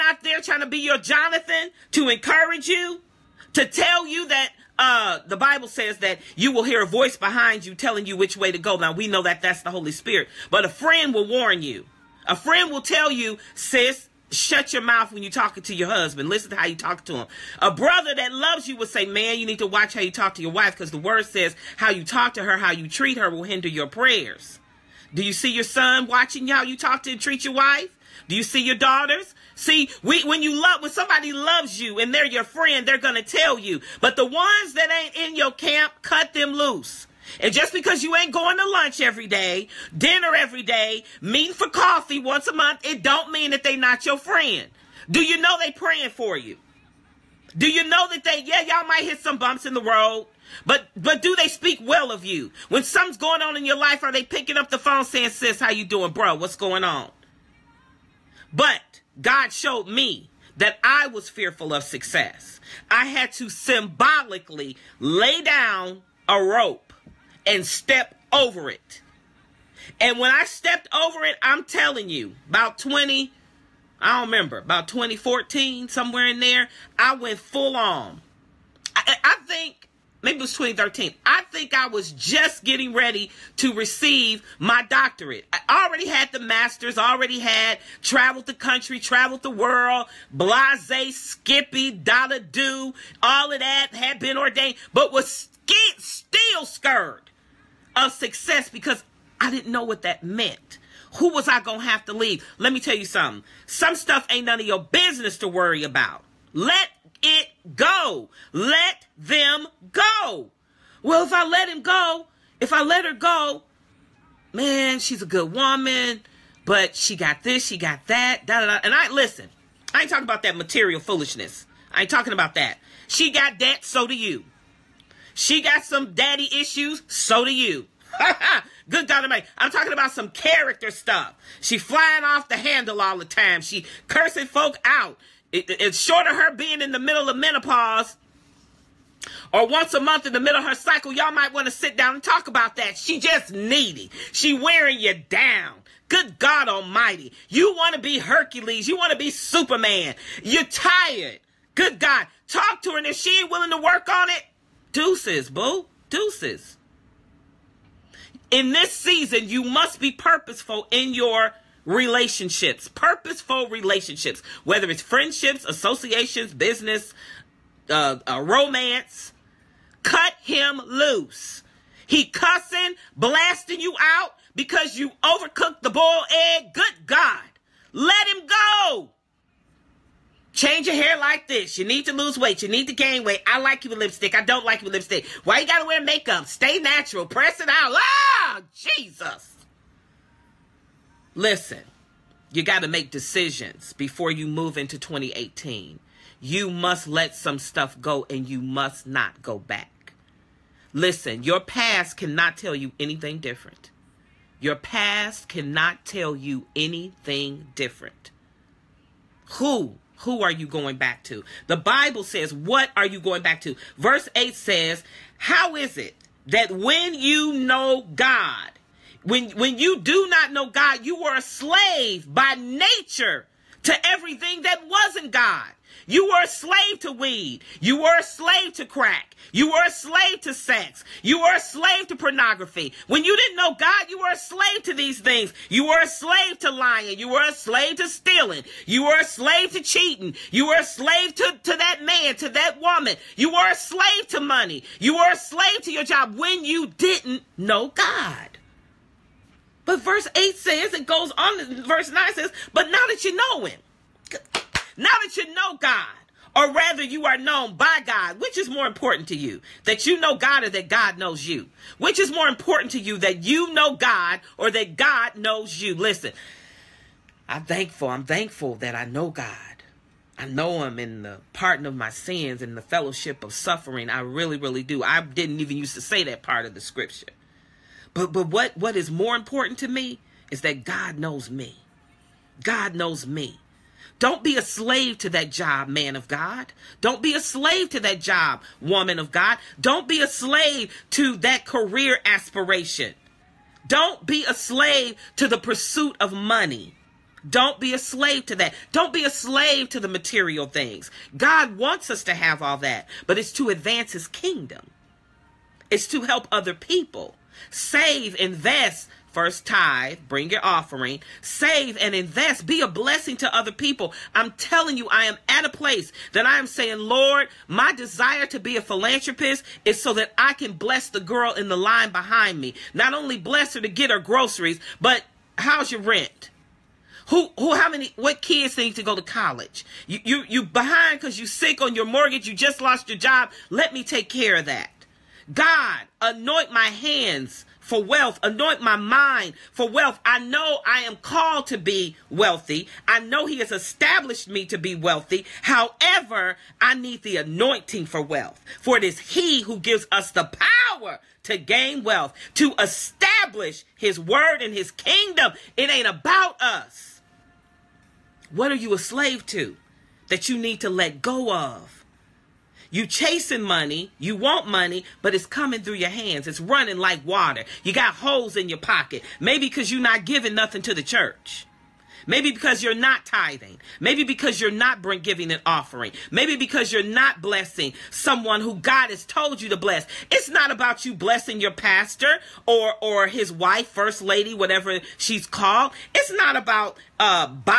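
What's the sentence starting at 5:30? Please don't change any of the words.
You, you, you behind because you sick on your mortgage.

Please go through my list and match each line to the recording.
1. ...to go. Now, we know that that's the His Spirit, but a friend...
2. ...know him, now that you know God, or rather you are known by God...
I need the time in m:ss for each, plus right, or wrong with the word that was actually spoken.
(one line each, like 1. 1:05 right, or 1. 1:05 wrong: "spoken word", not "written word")
1. 0:08 wrong: "Holy", not "His"
2. 4:13 right.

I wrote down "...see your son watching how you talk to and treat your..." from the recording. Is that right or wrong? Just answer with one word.
right.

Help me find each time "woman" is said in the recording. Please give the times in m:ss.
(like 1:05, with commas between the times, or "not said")
1:55, 4:02, 4:48.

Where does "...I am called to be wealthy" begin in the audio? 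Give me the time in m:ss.
5:40.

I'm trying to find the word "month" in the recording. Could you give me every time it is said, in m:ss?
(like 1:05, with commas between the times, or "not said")
0:42, 2:20.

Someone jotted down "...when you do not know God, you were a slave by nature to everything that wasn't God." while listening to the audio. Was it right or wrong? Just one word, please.
right.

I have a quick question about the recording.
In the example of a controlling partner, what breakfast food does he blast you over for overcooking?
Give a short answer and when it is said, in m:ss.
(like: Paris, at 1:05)
Boiled egg, at 2:55.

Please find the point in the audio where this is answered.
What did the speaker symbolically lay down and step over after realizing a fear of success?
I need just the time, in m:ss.
1:06.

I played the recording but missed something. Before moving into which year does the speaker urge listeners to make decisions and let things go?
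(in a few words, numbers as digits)
2018.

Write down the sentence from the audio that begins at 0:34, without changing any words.
But the ones that ain't in your camp, cut them loose.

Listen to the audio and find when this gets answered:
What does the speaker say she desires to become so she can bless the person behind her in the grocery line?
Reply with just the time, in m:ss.
5:18.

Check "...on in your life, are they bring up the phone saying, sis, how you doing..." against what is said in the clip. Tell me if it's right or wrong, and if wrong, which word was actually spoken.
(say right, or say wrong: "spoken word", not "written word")
wrong: "picking", not "bring".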